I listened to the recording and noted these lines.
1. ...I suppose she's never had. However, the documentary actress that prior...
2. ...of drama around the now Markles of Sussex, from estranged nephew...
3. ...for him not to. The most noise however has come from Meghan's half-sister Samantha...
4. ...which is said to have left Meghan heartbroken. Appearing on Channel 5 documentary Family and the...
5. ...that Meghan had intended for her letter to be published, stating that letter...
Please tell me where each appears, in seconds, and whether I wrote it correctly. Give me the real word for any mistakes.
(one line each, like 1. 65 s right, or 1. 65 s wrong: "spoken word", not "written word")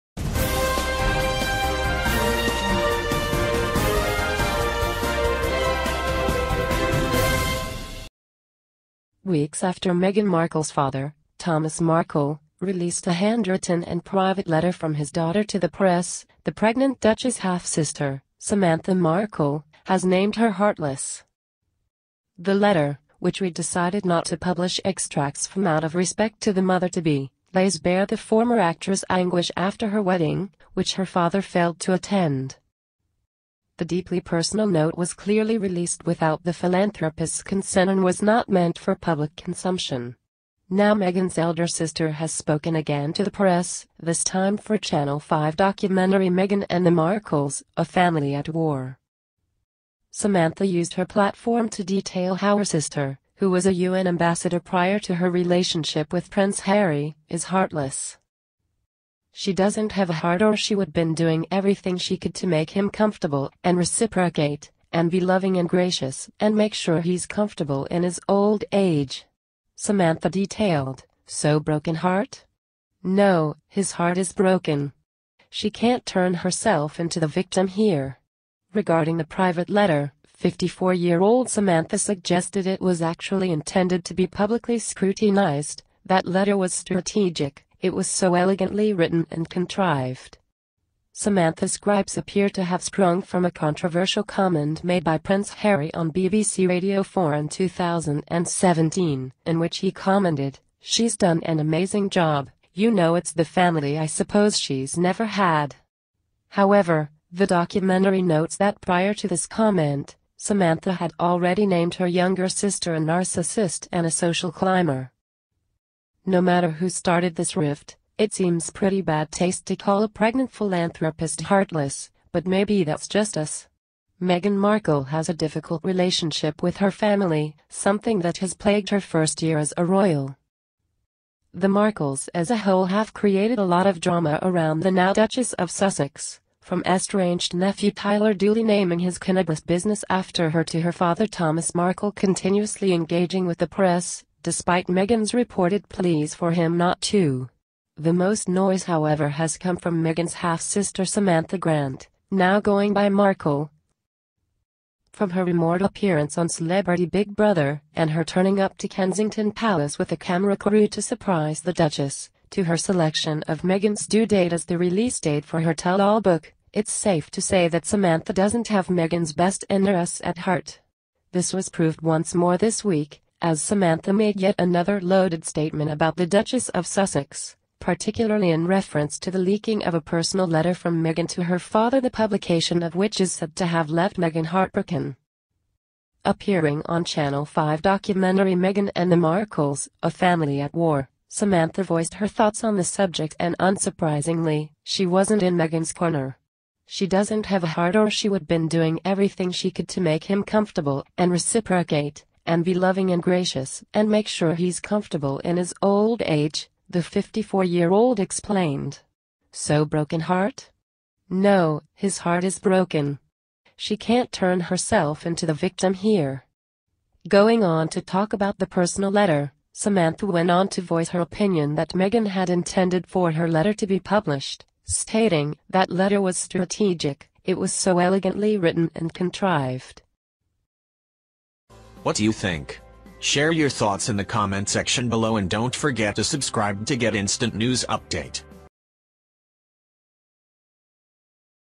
1. 103 s wrong: "notes", not "actress"
2. 133 s wrong: "Duchess", not "Markles"
3. 146 s right
4. 182 s wrong: "Meghan", not "Family"
5. 221 s right.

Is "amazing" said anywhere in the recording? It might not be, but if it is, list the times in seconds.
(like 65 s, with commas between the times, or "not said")
101 s.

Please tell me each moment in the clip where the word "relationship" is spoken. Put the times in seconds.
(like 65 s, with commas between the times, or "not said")
55 s, 125 s.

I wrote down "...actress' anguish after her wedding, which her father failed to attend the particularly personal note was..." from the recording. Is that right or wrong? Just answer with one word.
wrong.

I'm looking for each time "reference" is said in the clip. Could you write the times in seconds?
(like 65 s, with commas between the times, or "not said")
178 s.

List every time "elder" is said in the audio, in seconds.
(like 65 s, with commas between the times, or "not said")
41 s.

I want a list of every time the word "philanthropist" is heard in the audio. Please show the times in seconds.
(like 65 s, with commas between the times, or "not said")
36 s, 120 s.